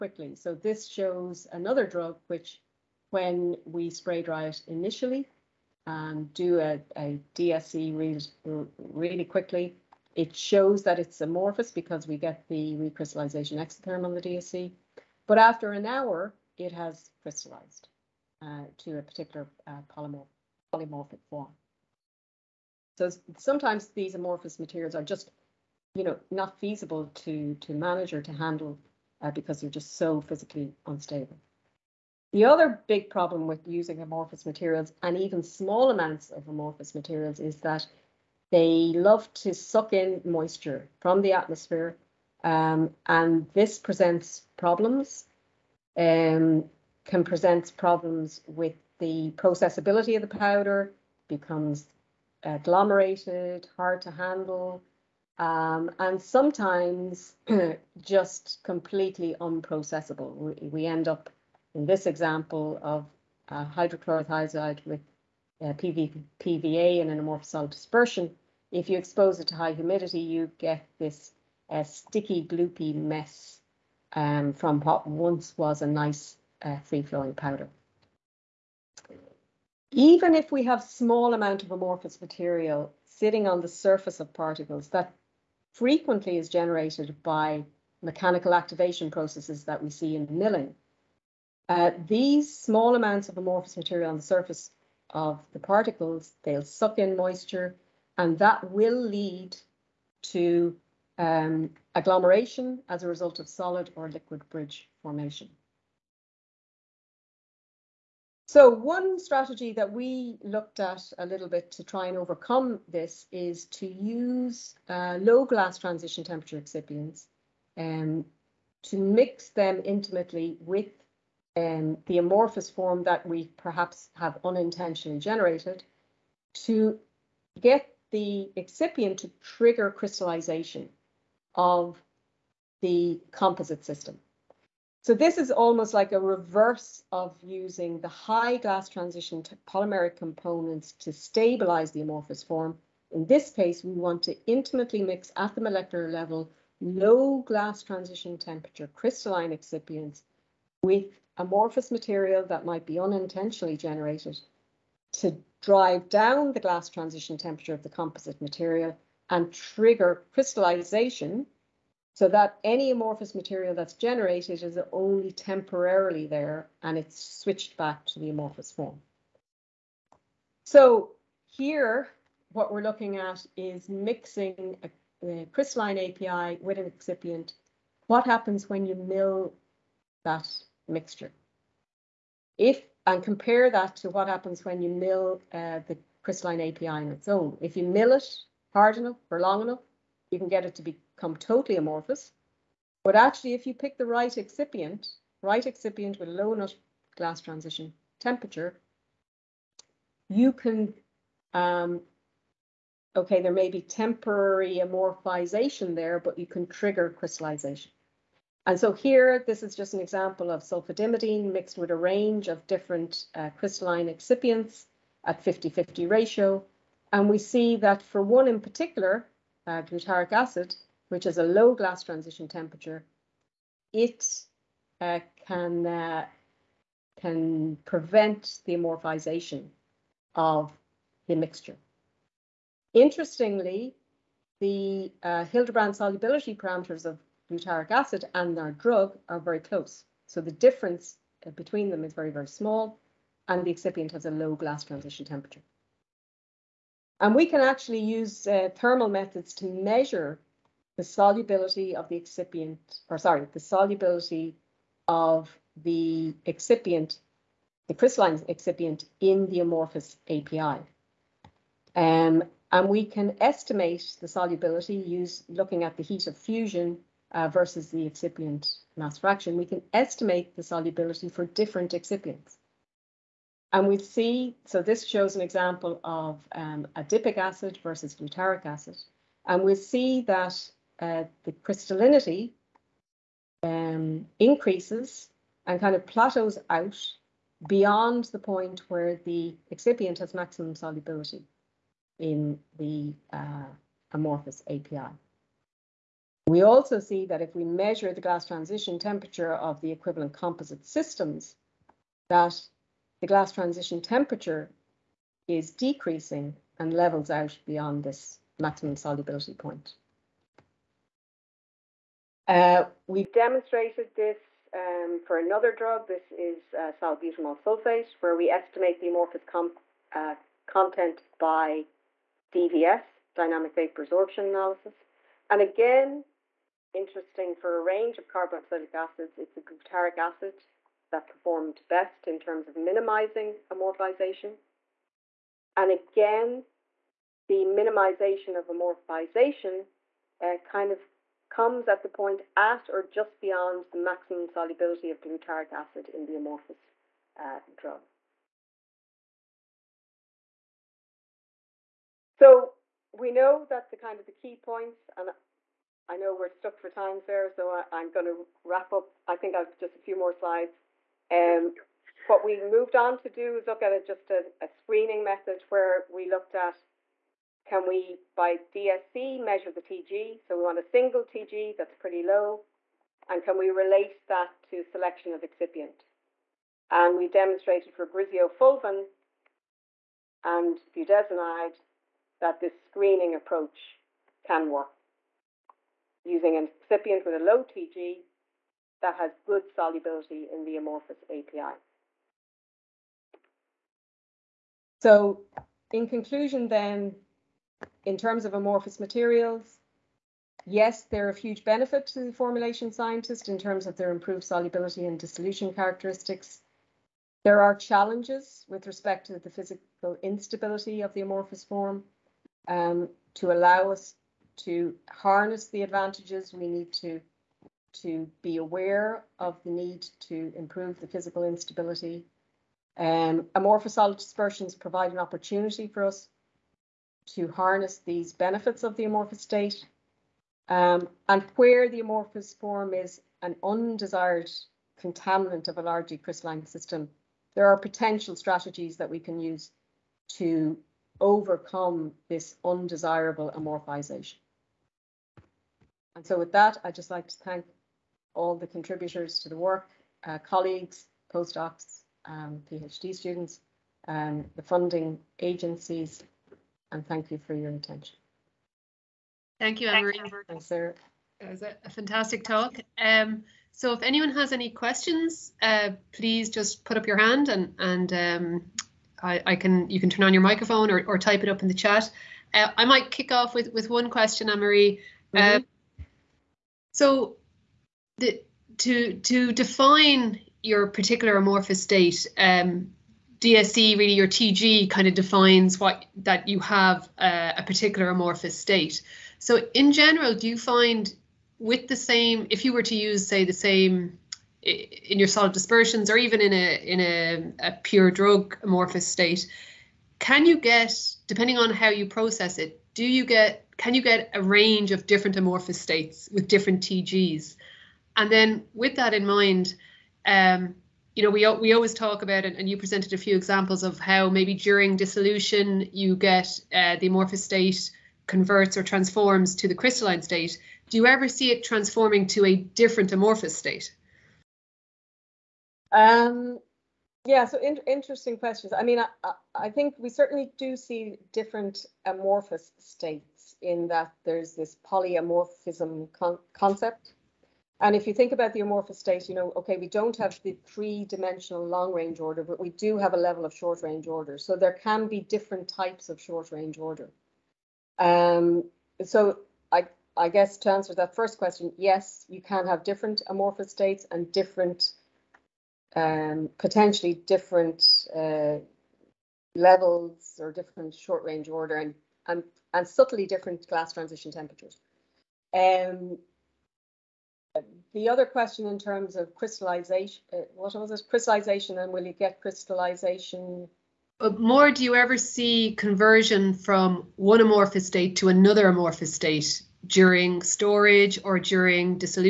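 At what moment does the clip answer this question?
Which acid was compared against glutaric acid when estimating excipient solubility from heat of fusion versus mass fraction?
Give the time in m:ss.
4:36.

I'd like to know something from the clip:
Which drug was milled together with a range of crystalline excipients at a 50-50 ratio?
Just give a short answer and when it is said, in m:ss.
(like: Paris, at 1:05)
Sulfadimidine, at 3:30.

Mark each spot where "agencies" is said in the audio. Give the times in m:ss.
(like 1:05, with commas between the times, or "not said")
7:35.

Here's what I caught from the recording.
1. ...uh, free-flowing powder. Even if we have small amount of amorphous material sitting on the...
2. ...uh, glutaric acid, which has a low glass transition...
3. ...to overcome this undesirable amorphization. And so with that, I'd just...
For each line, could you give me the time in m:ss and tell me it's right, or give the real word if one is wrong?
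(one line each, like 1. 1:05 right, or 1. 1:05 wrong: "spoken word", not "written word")
1. 1:16 right
2. 3:39 right
3. 7:20 right.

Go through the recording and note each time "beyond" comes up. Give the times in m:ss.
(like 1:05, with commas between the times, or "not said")
4:47, 5:07, 5:43.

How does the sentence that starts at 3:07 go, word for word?
If you mill it hard enough or long enough, you can get it to become totally amorphous.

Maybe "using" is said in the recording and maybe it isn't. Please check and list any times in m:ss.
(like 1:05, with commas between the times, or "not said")
0:33, 2:17, 6:26.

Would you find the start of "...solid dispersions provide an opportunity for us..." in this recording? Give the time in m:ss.
7:03.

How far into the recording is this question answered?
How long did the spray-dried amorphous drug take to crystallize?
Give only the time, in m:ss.
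0:15.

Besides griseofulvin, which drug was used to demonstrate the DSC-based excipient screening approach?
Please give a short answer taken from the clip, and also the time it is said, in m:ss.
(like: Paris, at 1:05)
Budesonide, at 6:20.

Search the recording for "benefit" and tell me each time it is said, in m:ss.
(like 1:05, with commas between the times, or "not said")
6:41, 7:08.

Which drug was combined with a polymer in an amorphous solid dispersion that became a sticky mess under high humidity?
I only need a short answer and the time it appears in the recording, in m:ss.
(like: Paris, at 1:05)
Hydrochlorothiazide, at 1:03.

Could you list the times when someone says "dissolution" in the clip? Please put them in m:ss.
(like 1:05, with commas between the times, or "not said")
6:45, 8:34.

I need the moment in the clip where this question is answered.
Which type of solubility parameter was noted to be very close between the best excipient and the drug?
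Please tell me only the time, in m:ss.
3:55.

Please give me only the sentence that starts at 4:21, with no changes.
Um, and we can estimate the solubility use looking at the heat of fusion uh, versus the excipient mass fraction.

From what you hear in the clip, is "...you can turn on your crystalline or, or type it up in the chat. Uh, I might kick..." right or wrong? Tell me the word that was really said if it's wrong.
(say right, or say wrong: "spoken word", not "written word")
wrong: "microphone", not "crystalline".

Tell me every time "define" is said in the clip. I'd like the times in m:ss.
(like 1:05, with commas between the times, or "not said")
7:59, 8:05.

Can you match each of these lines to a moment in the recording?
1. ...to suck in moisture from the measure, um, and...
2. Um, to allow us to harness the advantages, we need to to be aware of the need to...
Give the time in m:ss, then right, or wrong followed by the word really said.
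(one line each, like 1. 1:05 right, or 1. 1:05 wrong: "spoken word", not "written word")
1. 0:39 wrong: "atmosphere", not "measure"
2. 6:52 right.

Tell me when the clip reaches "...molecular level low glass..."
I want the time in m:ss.
2:25.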